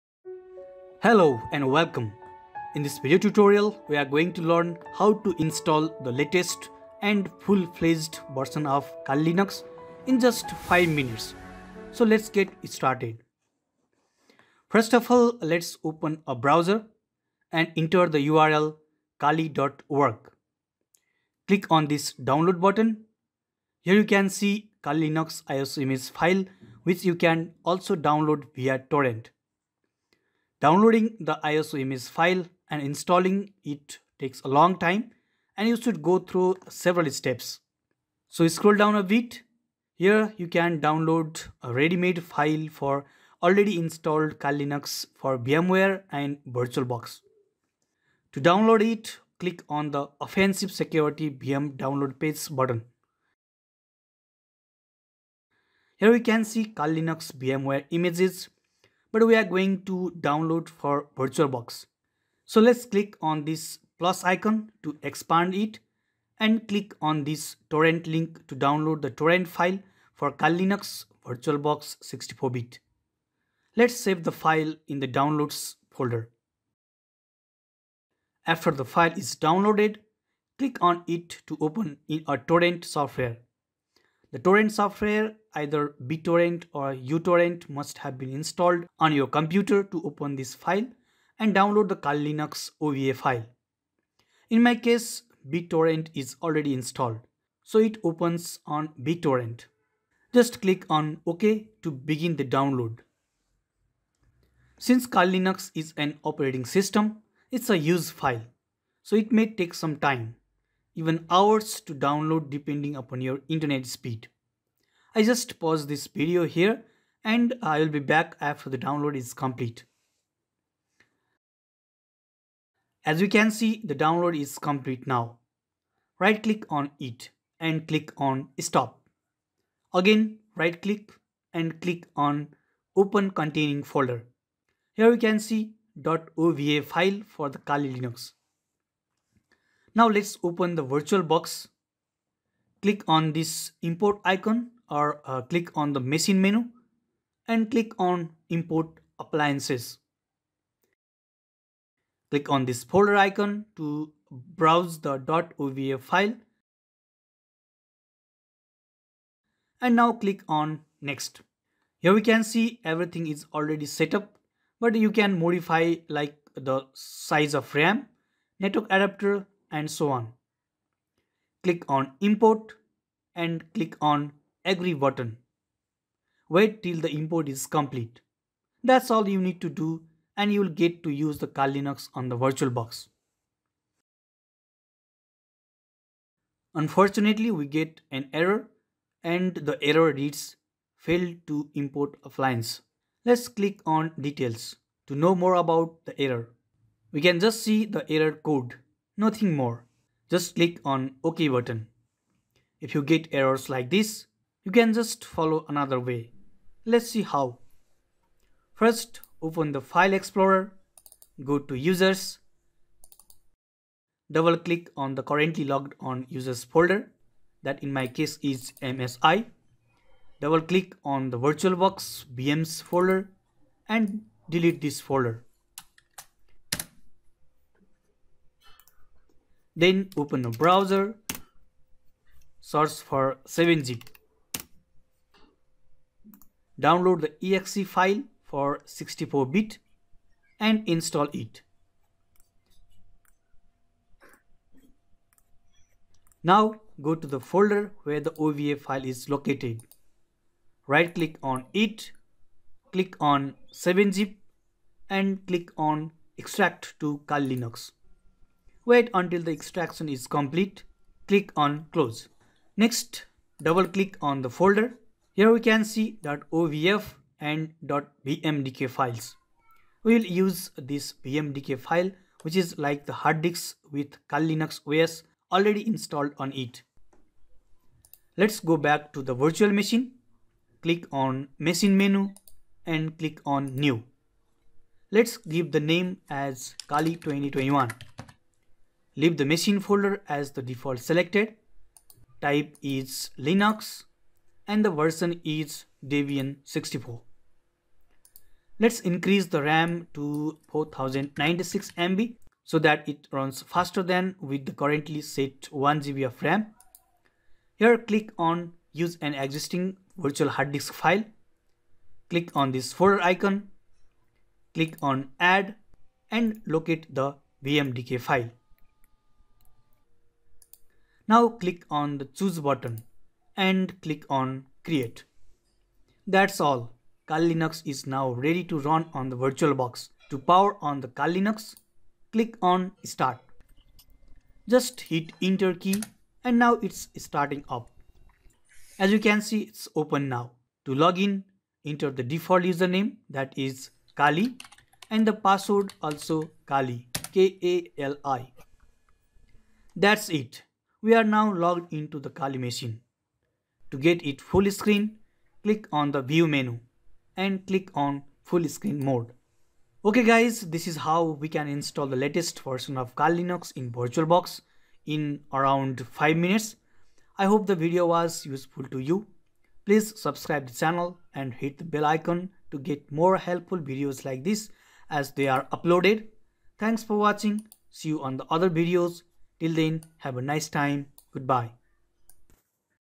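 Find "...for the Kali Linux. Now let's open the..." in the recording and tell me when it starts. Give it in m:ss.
2:17.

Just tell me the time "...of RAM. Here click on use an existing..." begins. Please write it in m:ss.
5:06.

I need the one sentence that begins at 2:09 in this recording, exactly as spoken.
Again, right click and click on open containing folder.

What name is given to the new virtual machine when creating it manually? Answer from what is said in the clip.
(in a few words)
Kali 2021.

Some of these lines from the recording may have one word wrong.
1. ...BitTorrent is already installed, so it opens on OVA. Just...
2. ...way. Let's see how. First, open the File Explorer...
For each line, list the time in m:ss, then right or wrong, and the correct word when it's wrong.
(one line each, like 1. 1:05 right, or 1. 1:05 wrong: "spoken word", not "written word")
1. 1:35 wrong: "BitTorrent", not "OVA"
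2. 3:25 right.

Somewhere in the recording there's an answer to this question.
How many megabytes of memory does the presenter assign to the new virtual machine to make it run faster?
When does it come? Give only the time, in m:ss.
5:00.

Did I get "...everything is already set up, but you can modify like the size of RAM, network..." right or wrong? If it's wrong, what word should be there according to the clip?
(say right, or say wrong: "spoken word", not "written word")
right.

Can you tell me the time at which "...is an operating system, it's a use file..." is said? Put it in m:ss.
1:45.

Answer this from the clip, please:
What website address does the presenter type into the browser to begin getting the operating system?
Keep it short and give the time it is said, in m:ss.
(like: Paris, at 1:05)
kali.org, at 0:19.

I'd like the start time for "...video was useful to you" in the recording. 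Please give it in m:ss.
6:07.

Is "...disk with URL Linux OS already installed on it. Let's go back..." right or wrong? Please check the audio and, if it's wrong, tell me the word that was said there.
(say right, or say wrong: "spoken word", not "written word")
wrong: "Kali", not "URL".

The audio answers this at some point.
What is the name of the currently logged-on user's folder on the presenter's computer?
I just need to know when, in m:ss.
3:38.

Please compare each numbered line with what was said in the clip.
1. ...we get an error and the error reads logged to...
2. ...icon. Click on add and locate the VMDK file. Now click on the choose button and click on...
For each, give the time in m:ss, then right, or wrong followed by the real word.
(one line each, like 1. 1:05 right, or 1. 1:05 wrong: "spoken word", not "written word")
1. 3:07 wrong: "failed", not "logged"
2. 5:13 right.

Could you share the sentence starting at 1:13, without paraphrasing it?
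Let's save the file in the downloads folder.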